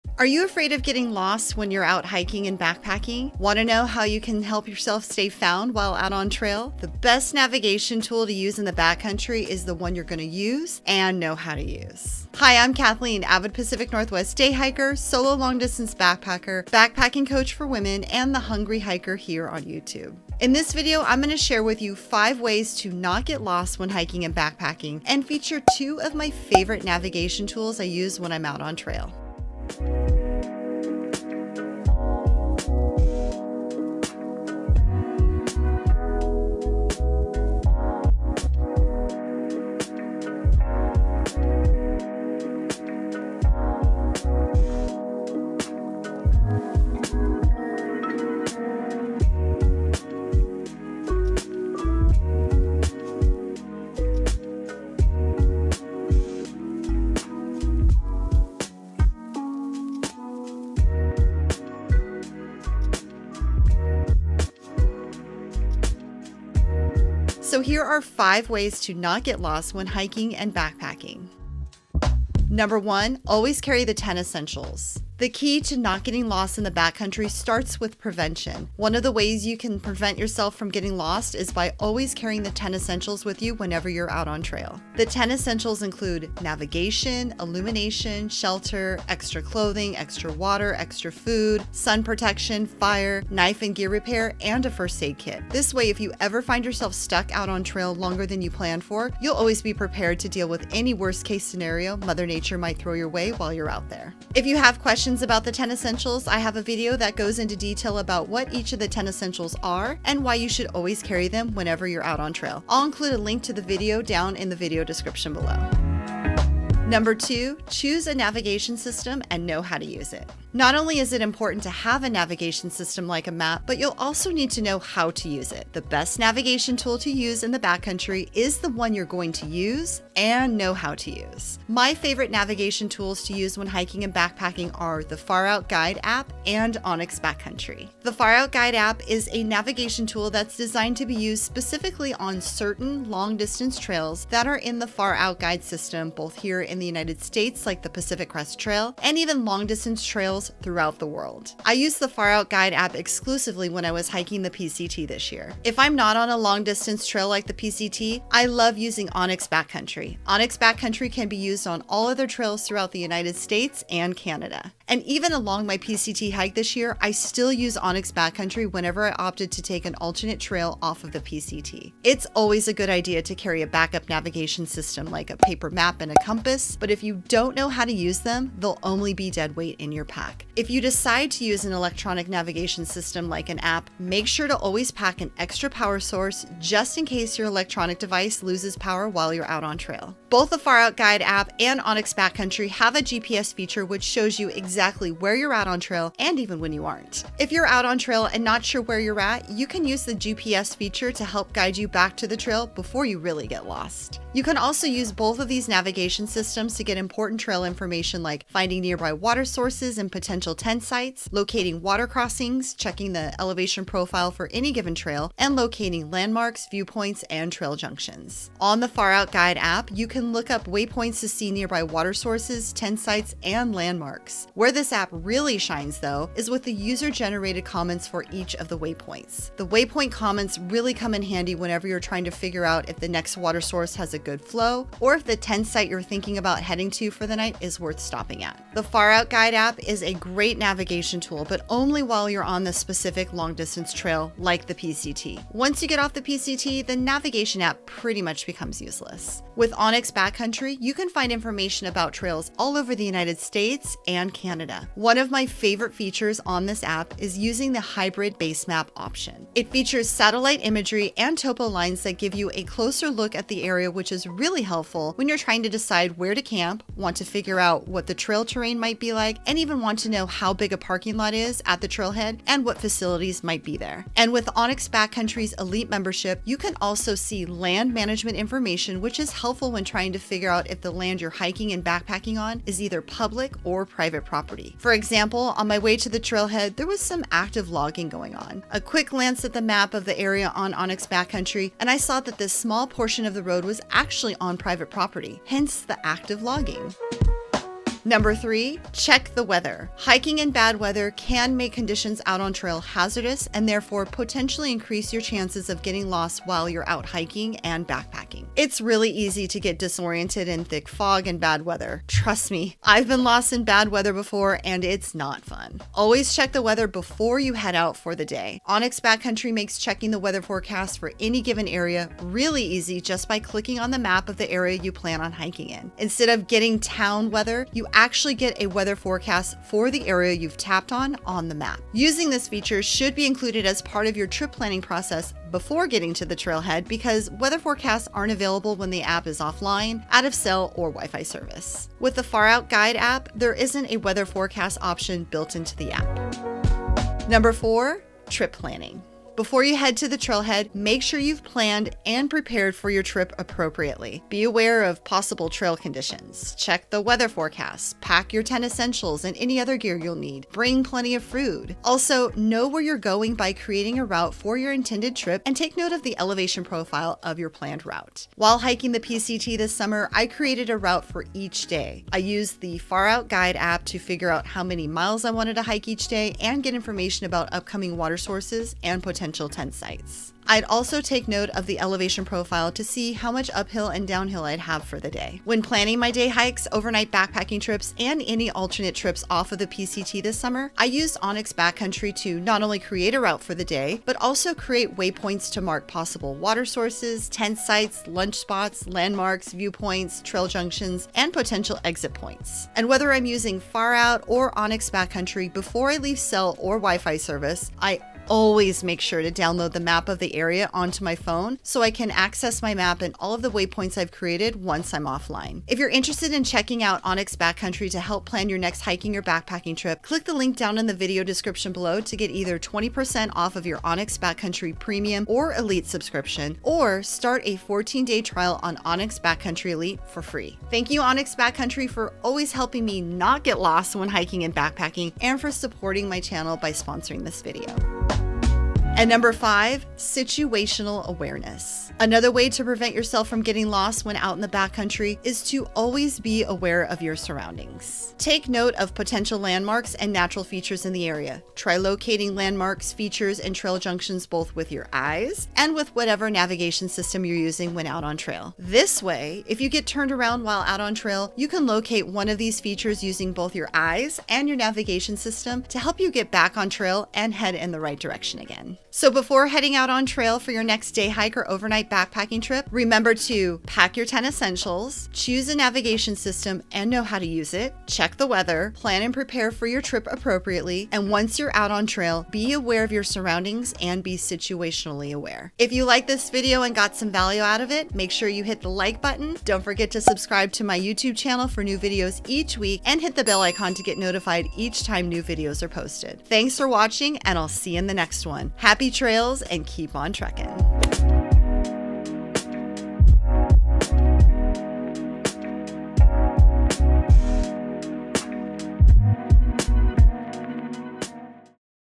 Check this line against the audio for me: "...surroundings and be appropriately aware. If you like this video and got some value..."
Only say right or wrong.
wrong.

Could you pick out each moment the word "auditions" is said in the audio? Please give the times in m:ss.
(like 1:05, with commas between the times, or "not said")
not said.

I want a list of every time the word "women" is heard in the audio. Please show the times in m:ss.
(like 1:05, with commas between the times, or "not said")
0:17.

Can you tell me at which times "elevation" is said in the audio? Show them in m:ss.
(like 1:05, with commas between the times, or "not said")
3:33, 6:06, 6:21.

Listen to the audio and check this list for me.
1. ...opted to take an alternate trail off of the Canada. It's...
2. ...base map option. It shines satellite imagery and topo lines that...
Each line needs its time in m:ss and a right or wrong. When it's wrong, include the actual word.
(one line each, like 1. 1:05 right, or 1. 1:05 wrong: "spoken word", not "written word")
1. 2:49 wrong: "PCT", not "Canada"
2. 4:18 wrong: "features", not "shines".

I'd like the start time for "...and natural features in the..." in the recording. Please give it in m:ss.
7:29.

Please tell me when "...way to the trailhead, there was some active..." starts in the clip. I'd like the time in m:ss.
4:45.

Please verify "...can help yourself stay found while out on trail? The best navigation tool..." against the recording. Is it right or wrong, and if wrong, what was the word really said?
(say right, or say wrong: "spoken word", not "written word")
right.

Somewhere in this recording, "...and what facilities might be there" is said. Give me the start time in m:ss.
4:32.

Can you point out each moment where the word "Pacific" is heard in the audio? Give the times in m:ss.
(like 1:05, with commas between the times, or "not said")
0:13, 2:27.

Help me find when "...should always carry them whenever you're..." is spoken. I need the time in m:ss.
1:50.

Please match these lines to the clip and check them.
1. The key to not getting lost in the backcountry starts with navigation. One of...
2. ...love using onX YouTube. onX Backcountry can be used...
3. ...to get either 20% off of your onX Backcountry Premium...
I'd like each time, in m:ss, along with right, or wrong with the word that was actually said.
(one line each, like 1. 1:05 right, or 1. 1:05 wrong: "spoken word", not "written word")
1. 1:15 wrong: "prevention", not "navigation"
2. 2:38 wrong: "Backcountry", not "YouTube"
3. 7:01 right.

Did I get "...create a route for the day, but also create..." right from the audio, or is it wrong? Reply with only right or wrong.
right.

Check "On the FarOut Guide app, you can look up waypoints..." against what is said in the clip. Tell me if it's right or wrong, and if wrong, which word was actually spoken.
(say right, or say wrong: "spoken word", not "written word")
right.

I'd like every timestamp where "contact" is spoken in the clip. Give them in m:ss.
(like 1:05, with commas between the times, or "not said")
not said.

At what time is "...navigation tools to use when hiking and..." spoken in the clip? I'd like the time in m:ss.
2:12.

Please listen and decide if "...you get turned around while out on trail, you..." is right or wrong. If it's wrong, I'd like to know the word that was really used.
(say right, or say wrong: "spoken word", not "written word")
right.